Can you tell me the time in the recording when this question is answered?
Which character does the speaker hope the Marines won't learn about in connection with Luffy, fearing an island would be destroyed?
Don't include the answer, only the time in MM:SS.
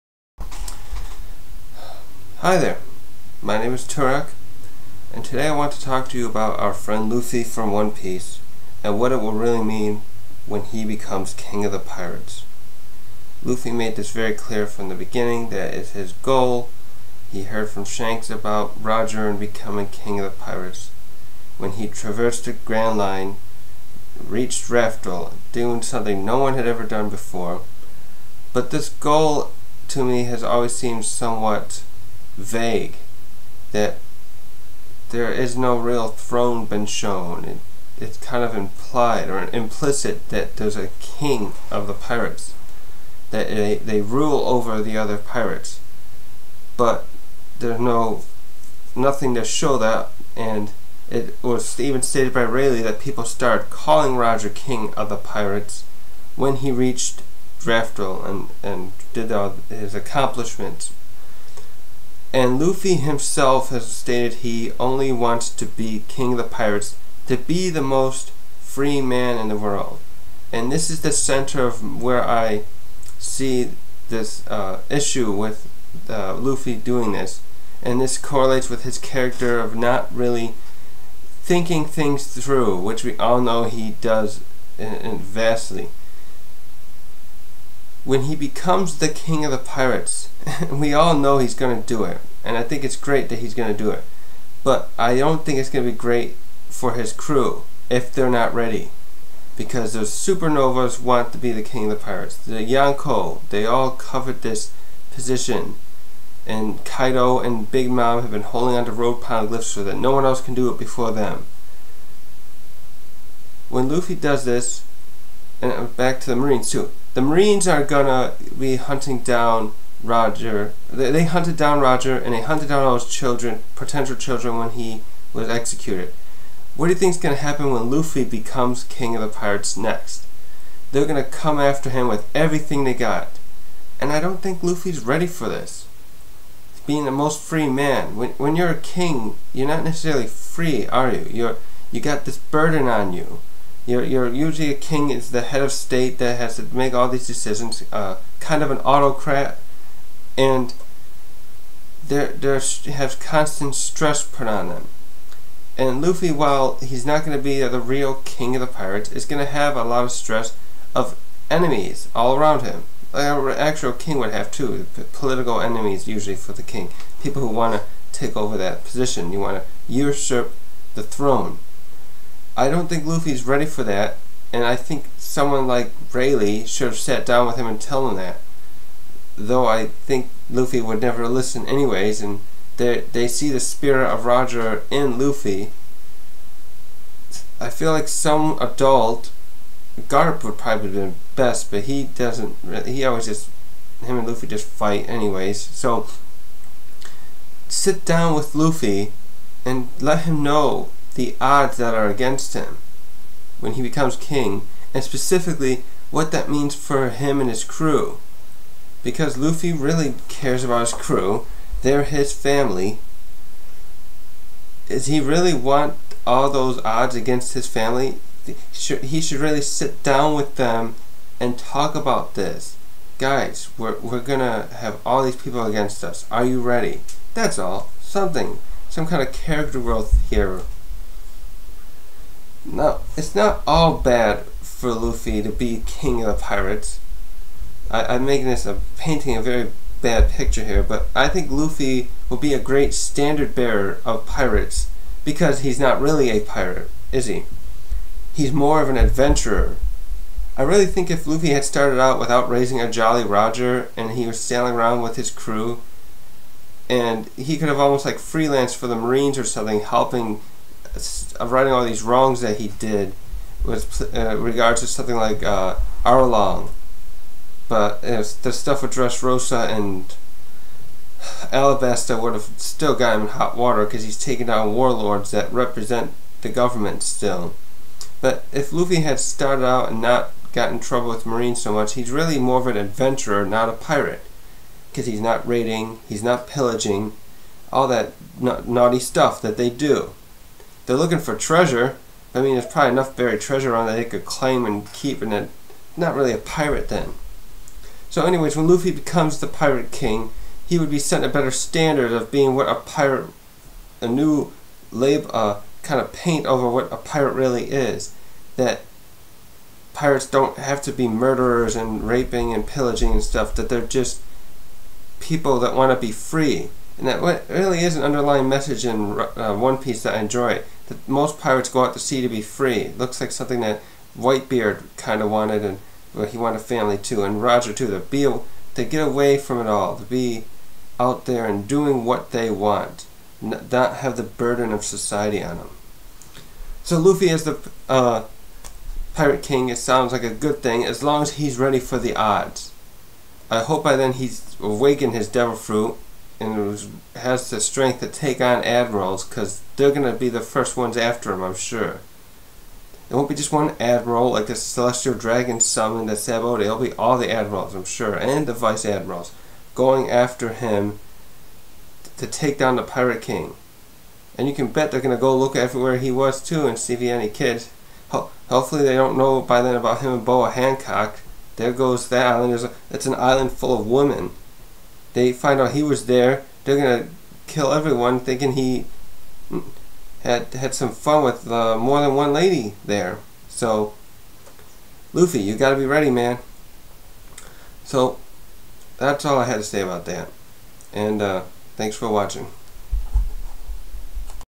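06:10.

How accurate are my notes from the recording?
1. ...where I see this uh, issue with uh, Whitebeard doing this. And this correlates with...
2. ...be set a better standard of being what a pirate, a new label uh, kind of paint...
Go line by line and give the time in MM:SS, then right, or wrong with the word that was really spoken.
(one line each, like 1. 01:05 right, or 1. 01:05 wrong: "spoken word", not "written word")
1. 01:12 wrong: "Luffy", not "Whitebeard"
2. 05:00 right.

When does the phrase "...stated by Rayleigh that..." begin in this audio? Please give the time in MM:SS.
00:52.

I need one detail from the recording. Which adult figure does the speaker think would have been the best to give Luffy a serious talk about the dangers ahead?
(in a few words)
Garp.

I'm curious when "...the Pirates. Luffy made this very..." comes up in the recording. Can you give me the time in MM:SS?
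00:11.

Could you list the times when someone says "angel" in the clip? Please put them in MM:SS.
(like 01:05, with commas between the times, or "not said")
not said.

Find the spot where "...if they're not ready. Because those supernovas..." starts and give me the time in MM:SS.
01:37.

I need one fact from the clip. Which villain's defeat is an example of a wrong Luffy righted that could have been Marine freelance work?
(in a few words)
Arlong.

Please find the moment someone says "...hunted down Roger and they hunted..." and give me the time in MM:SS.
02:01.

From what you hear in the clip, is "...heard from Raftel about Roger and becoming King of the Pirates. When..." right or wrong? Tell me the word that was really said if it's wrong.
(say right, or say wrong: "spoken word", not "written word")
wrong: "Shanks", not "Raftel".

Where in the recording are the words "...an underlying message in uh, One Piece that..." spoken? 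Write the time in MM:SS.
05:17.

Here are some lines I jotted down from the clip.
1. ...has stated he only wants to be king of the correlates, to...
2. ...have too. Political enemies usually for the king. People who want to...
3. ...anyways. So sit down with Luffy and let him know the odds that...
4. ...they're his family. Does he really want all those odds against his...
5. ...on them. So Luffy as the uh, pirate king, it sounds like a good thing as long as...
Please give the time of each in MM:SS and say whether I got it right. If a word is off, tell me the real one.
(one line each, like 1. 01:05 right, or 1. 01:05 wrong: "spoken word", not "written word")
1. 01:03 wrong: "pirates", not "correlates"
2. 02:44 right
3. 03:15 right
4. 03:31 right
5. 05:35 right.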